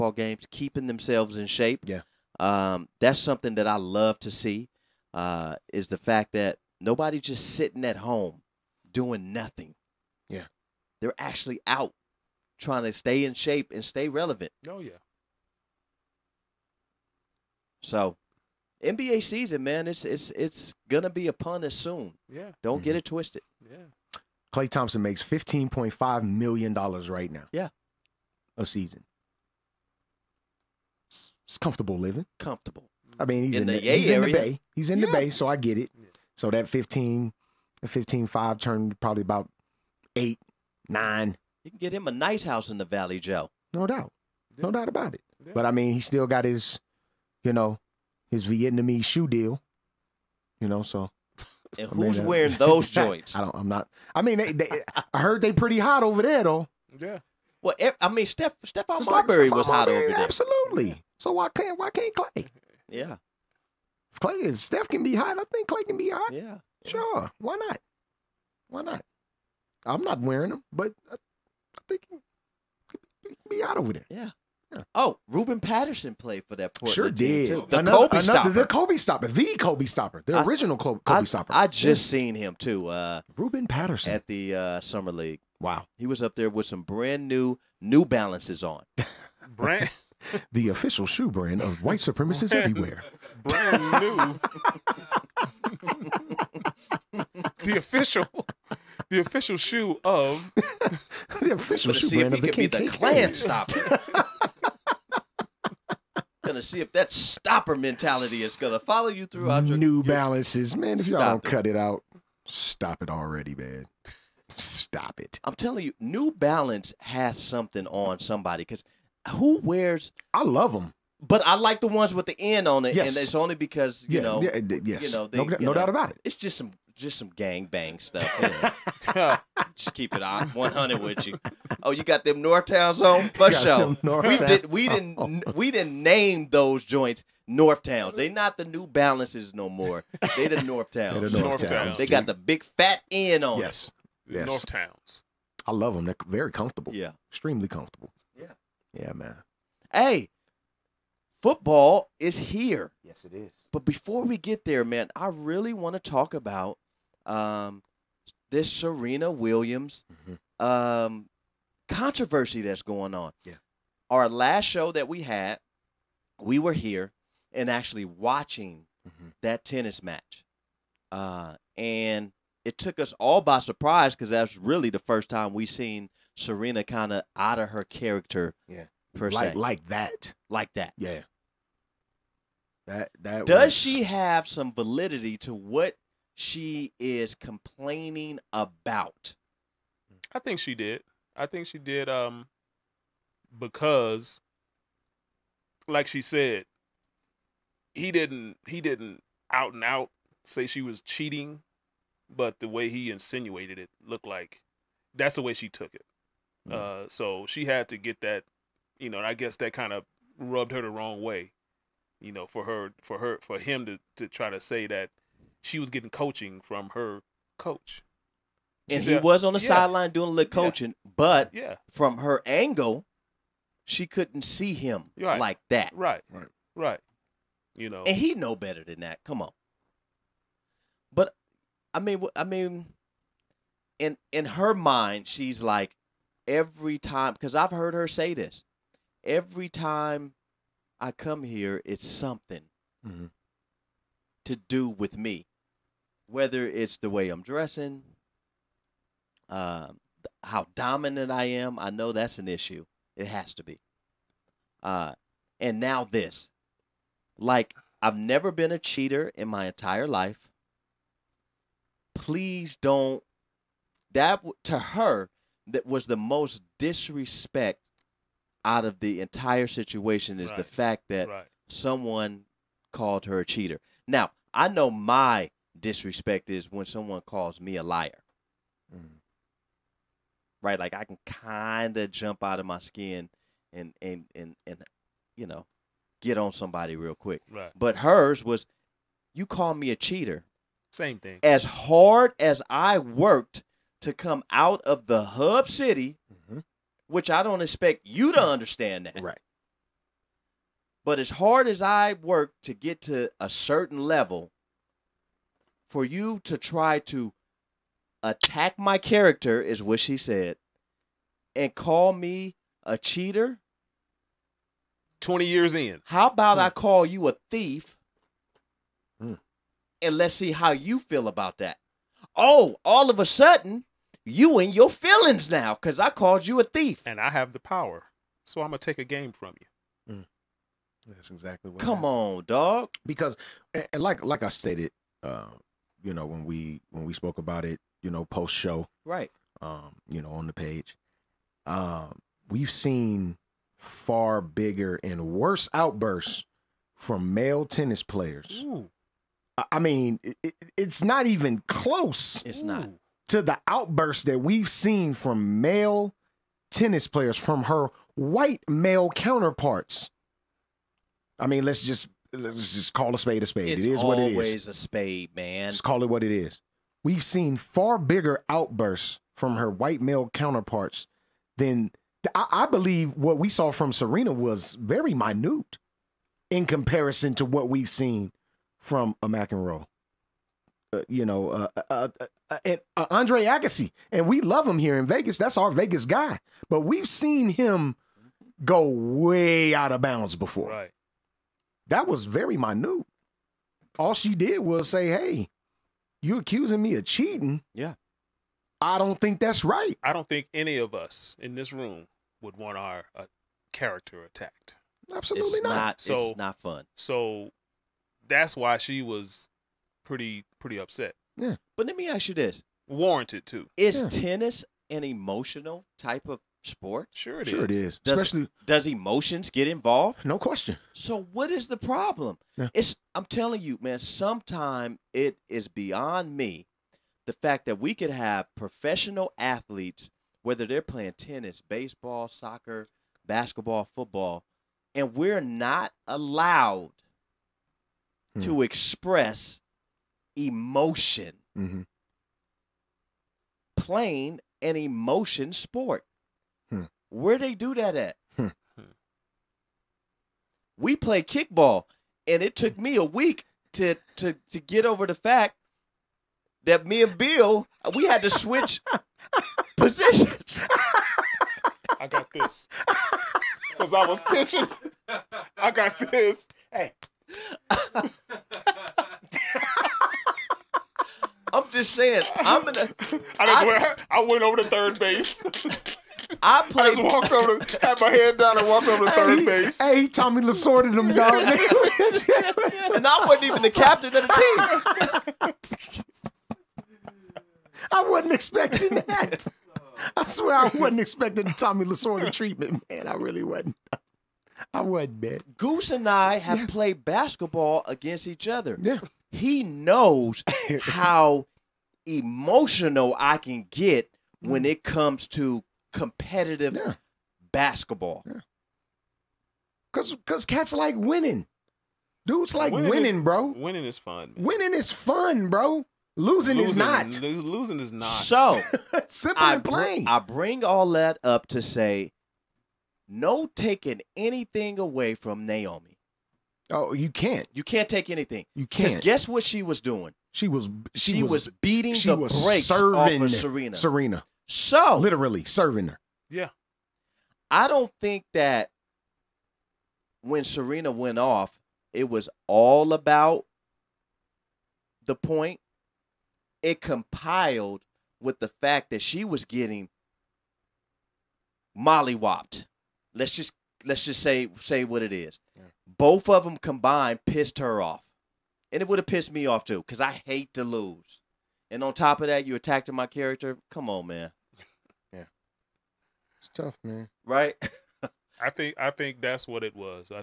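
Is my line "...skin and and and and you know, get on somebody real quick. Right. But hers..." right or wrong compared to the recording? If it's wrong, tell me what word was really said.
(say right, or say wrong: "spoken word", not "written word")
right.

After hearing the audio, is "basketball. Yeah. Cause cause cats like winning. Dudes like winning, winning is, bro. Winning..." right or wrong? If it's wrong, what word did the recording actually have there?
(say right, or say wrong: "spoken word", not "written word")
right.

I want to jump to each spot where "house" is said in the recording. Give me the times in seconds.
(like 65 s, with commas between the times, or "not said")
42 s.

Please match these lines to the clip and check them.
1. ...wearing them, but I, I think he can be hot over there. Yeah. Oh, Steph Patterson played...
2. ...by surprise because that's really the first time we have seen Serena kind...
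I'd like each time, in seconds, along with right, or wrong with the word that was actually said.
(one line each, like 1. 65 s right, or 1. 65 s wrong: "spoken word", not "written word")
1. 70 s wrong: "Ruben", not "Steph"
2. 173 s right.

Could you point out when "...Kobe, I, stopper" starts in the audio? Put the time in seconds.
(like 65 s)
80 s.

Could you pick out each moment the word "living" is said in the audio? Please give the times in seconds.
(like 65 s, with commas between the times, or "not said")
31 s.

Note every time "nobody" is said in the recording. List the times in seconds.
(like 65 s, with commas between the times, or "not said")
6 s.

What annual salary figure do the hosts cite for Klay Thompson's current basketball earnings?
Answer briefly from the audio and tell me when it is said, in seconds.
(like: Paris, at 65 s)
$15.5 million, at 25 s.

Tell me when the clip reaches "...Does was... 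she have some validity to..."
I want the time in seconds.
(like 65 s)
183 s.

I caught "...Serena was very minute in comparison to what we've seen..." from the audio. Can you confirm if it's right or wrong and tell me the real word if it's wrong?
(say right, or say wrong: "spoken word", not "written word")
right.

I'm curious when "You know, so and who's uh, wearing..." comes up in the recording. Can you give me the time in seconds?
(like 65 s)
50 s.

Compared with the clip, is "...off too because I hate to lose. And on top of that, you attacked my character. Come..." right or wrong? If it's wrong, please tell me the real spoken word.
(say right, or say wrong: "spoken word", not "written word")
right.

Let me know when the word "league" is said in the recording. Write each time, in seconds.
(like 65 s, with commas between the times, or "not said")
85 s.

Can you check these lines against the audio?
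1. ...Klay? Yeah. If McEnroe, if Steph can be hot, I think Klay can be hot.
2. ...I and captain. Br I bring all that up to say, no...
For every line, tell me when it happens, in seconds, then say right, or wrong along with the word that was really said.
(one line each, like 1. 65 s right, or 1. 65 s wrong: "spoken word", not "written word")
1. 62 s wrong: "Klay", not "McEnroe"
2. 519 s wrong: "plain", not "captain".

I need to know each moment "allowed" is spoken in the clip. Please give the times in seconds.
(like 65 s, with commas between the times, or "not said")
436 s.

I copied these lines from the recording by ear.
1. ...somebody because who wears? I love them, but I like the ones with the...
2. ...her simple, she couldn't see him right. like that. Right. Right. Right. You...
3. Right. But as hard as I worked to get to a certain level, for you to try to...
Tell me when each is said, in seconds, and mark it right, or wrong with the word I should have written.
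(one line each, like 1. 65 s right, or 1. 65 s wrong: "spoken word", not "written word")
1. 118 s right
2. 222 s wrong: "angle", not "simple"
3. 299 s right.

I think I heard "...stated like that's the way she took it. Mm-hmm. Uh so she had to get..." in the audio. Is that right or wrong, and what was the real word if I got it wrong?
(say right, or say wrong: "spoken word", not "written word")
wrong: "looked", not "stated".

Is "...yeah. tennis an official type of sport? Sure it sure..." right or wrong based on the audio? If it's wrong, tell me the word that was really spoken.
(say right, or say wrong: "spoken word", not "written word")
wrong: "emotional", not "official".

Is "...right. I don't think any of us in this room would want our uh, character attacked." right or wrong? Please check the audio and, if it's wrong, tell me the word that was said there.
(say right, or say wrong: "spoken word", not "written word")
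right.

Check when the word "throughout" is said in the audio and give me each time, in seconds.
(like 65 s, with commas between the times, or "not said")
109 s.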